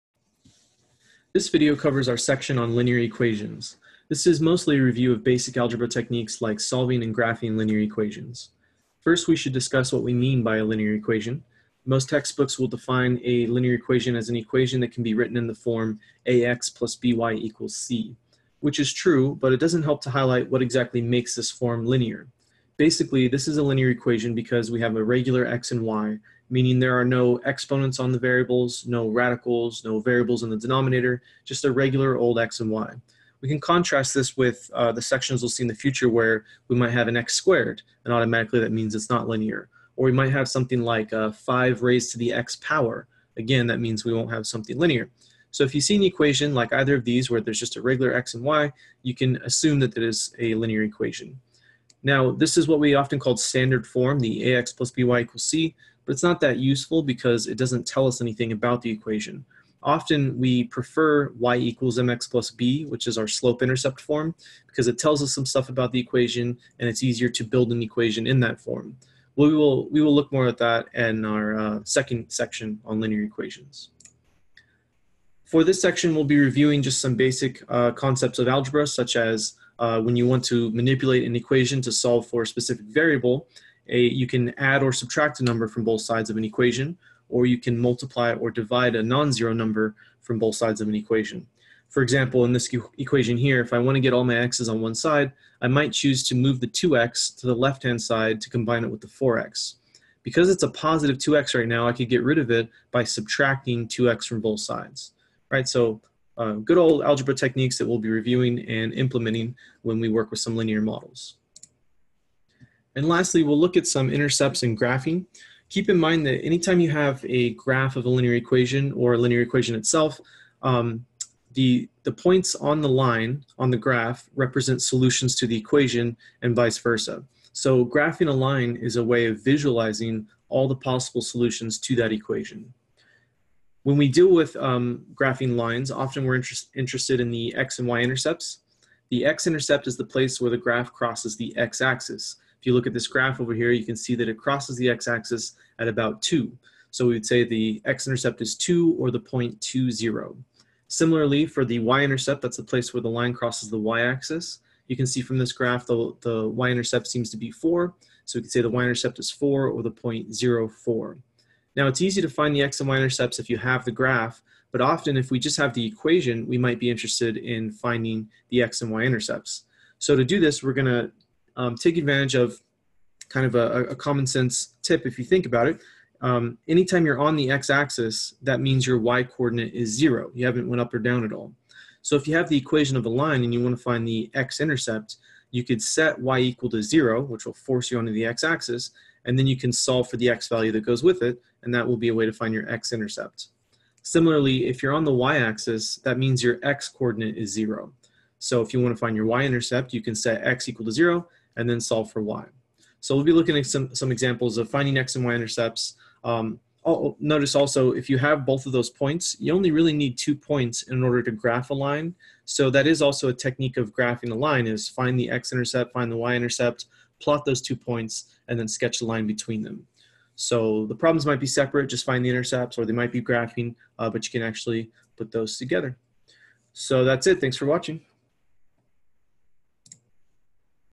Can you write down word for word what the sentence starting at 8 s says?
First, we should discuss what we mean by a linear equation.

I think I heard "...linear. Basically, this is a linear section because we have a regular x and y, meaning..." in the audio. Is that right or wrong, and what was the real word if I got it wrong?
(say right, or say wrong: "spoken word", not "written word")
wrong: "equation", not "section".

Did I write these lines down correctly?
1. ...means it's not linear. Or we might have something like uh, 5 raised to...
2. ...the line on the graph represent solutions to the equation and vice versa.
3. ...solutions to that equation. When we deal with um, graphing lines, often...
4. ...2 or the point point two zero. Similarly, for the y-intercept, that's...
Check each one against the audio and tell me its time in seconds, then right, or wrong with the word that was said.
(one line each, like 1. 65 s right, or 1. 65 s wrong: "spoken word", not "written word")
1. 38 s right
2. 122 s right
3. 131 s right
4. 148 s right.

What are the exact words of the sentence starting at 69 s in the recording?
we will, we will look more at that in our uh, second section on linear equations.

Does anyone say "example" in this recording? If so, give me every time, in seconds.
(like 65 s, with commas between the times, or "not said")
92 s, 204 s.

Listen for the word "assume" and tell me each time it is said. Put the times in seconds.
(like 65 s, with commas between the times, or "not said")
49 s.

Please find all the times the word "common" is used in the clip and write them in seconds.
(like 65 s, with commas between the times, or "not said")
173 s.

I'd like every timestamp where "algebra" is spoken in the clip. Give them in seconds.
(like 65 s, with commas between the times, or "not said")
5 s, 78 s, 107 s.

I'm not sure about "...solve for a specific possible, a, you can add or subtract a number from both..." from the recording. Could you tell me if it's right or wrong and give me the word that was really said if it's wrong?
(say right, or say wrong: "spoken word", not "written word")
wrong: "variable", not "possible".